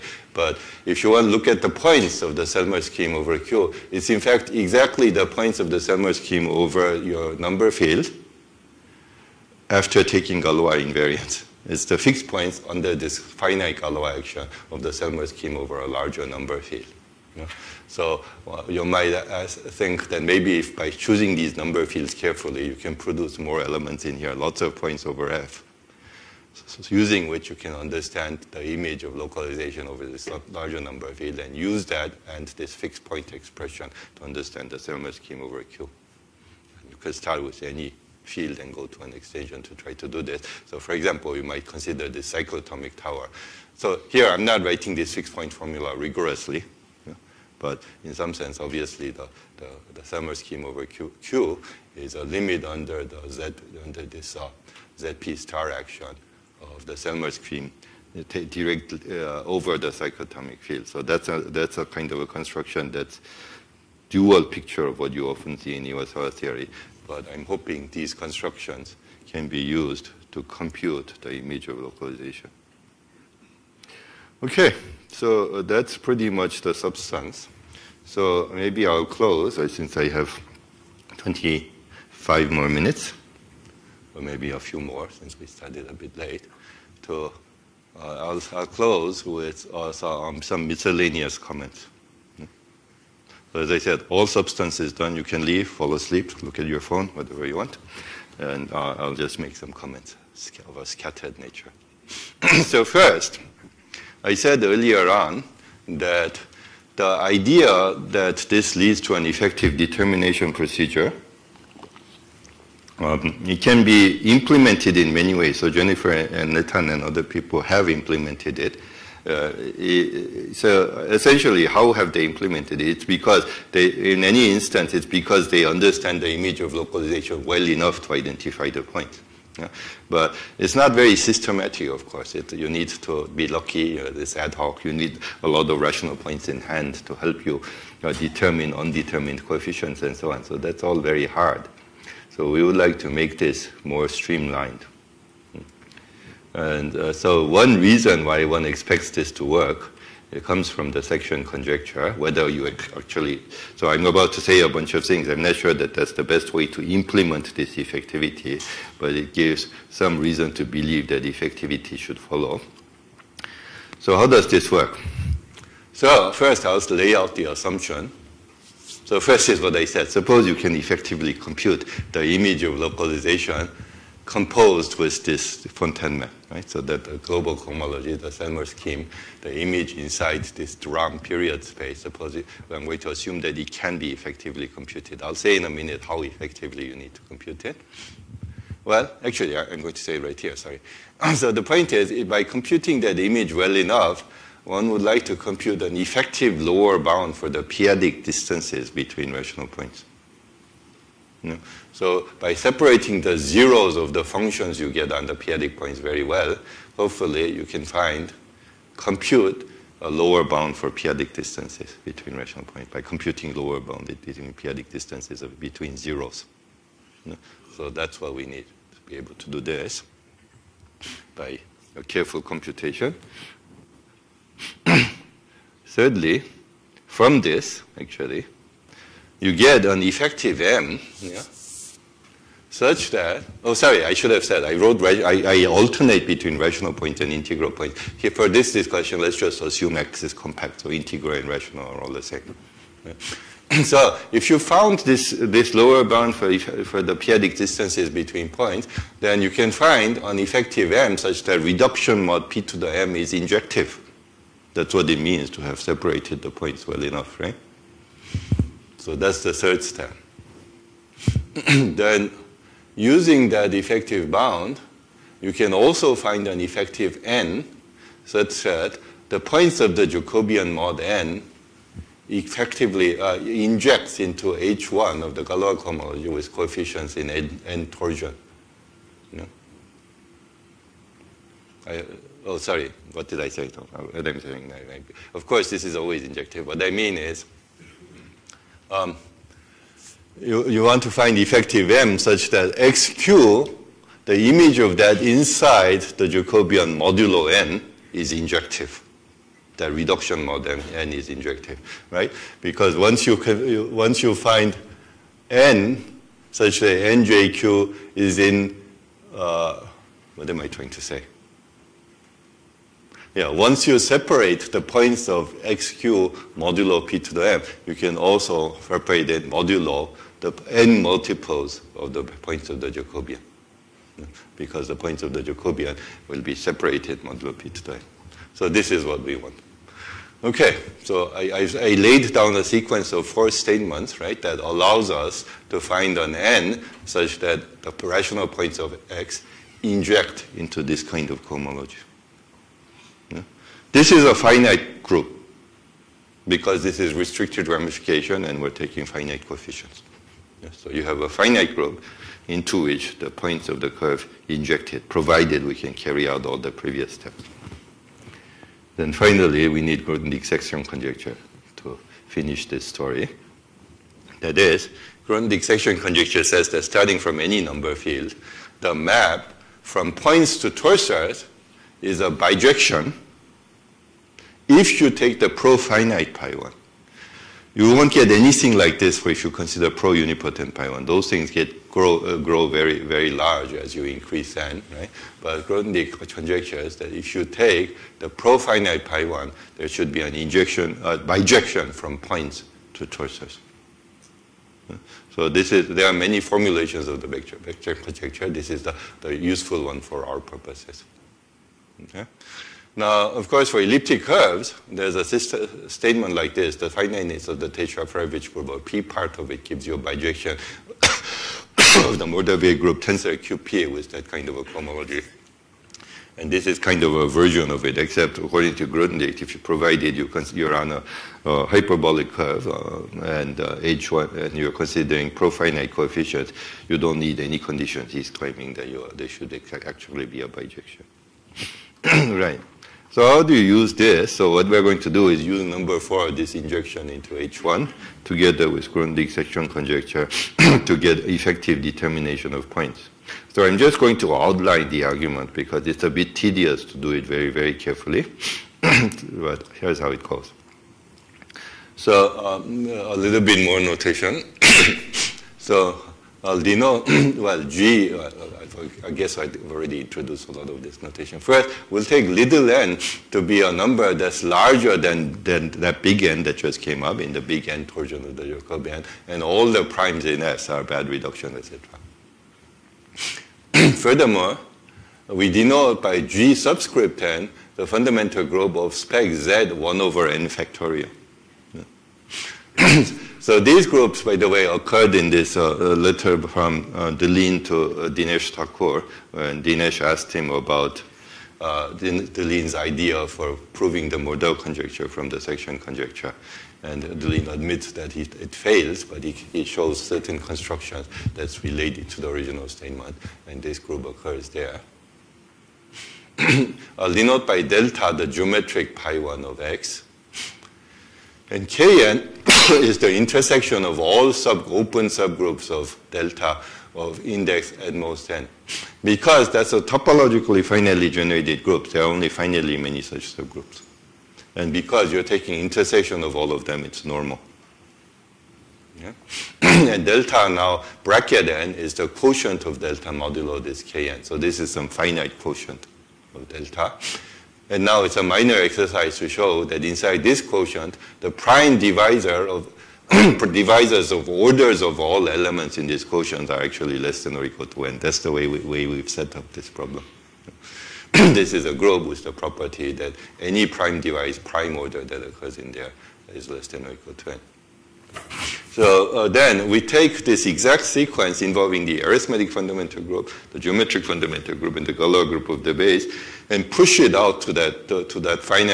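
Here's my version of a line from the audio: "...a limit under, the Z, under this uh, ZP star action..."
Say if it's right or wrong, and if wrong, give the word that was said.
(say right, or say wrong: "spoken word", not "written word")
right.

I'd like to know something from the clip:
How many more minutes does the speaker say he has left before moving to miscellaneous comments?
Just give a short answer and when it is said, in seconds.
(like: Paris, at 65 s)
25, at 81 s.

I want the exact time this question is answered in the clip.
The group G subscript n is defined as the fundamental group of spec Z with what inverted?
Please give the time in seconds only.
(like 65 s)
479 s.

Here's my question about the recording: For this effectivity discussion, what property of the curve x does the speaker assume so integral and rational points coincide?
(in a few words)
Compact.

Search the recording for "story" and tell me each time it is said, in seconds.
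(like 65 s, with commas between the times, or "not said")
362 s.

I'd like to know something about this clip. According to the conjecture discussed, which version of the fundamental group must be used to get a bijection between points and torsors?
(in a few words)
Profinite pi 1.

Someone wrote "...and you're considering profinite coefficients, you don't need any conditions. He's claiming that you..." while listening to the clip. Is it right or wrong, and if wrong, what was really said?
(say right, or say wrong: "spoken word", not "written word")
right.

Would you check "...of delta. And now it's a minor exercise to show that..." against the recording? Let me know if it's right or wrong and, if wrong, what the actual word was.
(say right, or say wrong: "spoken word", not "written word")
right.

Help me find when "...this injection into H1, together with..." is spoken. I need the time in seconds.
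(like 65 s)
436 s.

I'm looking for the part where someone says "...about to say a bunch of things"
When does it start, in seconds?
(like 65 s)
154 s.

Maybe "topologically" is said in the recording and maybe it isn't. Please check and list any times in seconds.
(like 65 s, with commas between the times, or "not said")
519 s.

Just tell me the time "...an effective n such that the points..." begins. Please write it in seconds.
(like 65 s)
266 s.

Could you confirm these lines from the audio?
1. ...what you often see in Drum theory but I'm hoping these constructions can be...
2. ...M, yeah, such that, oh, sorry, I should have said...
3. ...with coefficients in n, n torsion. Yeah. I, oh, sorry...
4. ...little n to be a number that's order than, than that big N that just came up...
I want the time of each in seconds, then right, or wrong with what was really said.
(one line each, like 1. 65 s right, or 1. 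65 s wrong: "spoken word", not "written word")
1. 64 s wrong: "Iwasawa", not "Drum"
2. 230 s right
3. 276 s right
4. 462 s wrong: "larger", not "order".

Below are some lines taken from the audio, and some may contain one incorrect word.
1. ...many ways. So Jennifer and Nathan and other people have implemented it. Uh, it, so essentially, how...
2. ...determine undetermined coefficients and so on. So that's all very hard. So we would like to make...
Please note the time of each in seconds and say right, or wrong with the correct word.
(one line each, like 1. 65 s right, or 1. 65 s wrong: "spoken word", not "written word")
1. 115 s right
2. 138 s right.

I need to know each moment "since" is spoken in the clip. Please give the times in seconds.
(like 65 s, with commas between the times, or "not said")
79 s, 85 s.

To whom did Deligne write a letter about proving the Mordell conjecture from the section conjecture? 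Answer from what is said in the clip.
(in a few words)
Dinesh Thakur.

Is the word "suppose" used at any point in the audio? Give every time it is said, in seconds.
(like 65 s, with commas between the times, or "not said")
170 s, 182 s.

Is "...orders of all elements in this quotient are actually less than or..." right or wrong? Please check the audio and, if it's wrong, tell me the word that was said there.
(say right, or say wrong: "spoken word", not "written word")
right.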